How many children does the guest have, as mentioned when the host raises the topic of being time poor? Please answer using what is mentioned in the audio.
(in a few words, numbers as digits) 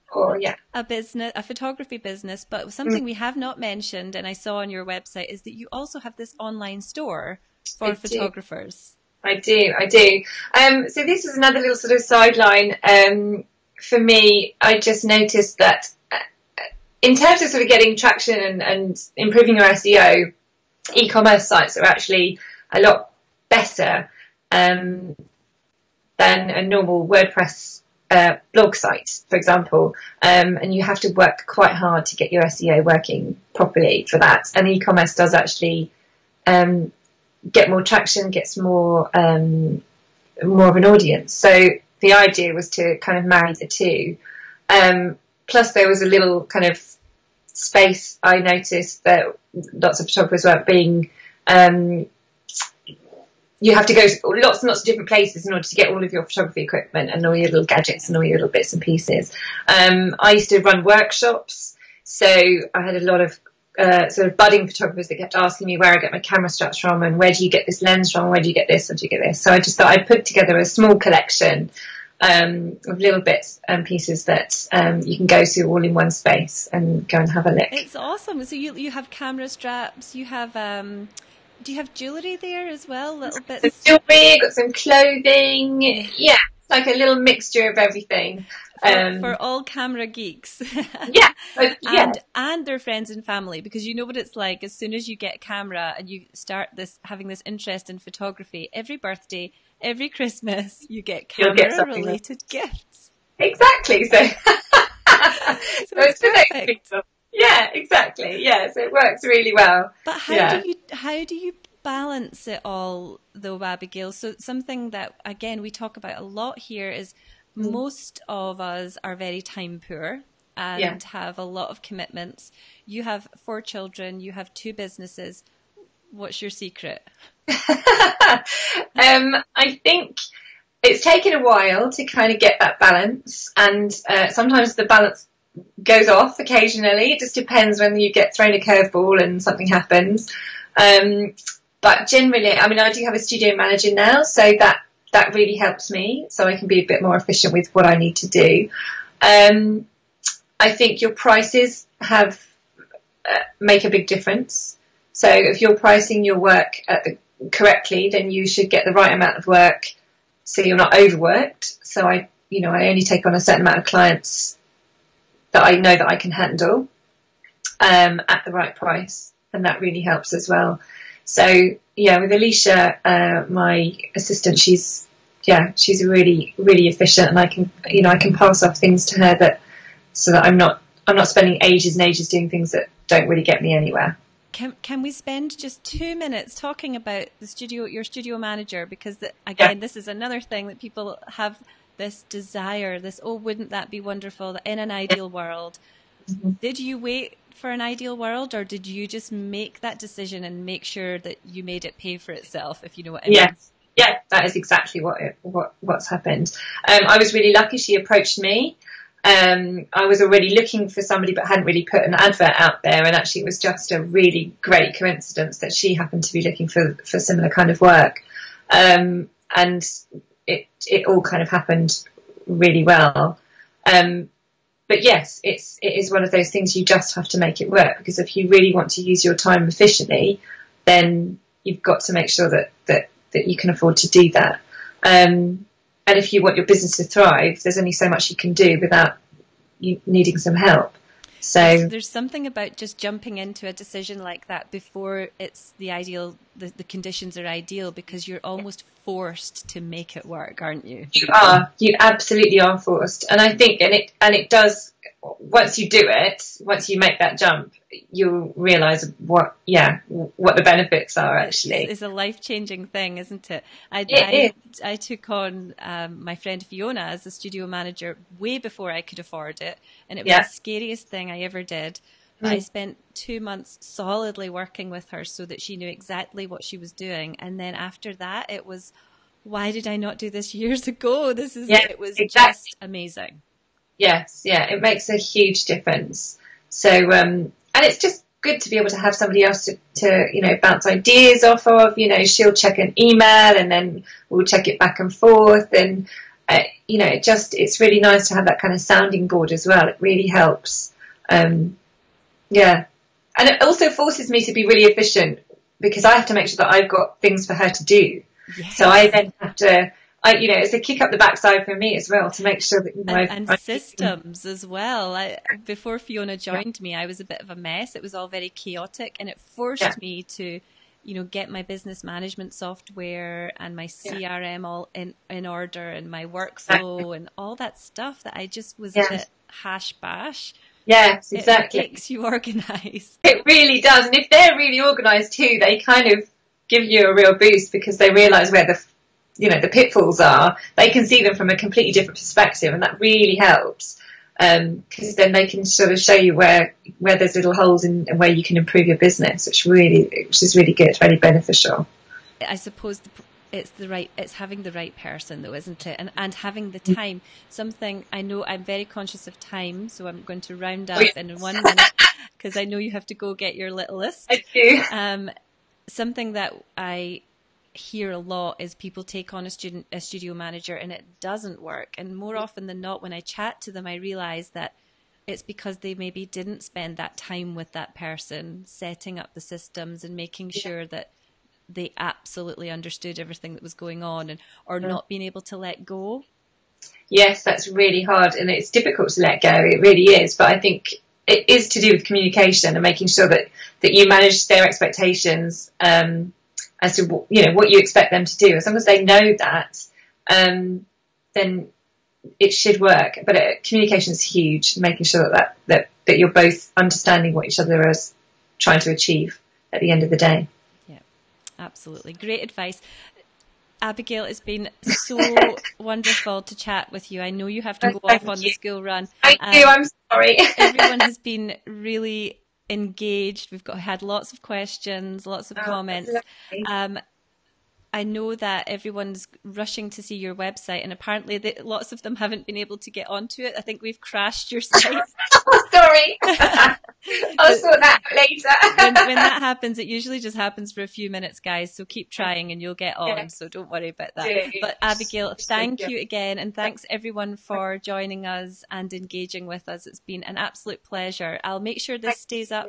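4.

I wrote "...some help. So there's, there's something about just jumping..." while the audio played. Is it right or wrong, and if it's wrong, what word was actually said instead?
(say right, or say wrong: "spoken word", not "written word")
right.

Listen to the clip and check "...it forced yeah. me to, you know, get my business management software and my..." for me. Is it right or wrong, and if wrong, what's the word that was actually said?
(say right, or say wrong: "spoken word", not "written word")
right.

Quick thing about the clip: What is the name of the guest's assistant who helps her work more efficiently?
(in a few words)
Alicia.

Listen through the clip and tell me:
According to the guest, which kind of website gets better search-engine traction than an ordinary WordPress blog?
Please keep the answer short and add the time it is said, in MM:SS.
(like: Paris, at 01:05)
E-commerce sites, at 00:20.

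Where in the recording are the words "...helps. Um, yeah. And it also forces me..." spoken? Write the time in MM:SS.
05:00.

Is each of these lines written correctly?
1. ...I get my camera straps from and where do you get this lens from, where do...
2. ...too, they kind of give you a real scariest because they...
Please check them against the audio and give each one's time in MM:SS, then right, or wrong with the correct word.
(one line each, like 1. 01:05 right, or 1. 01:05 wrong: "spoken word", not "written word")
1. 01:05 right
2. 05:35 wrong: "boost", not "scariest".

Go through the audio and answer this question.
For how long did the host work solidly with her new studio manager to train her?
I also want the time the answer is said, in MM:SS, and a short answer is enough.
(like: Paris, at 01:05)
2 months, at 04:33.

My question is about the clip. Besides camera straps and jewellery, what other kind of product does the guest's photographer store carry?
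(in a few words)
Clothing.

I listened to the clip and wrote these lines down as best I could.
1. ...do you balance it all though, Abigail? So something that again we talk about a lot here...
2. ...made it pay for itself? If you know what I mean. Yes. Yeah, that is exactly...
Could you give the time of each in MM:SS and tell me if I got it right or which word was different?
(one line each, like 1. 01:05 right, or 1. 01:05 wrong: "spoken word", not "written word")
1. 01:51 right
2. 03:21 right.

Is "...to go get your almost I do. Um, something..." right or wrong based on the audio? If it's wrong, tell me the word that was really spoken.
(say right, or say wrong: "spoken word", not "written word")
wrong: "littlest", not "almost".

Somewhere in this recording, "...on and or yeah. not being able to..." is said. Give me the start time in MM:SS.
06:24.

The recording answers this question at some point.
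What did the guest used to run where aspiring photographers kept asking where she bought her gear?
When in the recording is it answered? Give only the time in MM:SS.
01:00.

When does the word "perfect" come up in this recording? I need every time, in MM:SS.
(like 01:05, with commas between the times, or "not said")
01:46.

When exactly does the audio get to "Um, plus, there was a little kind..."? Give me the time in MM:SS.
00:44.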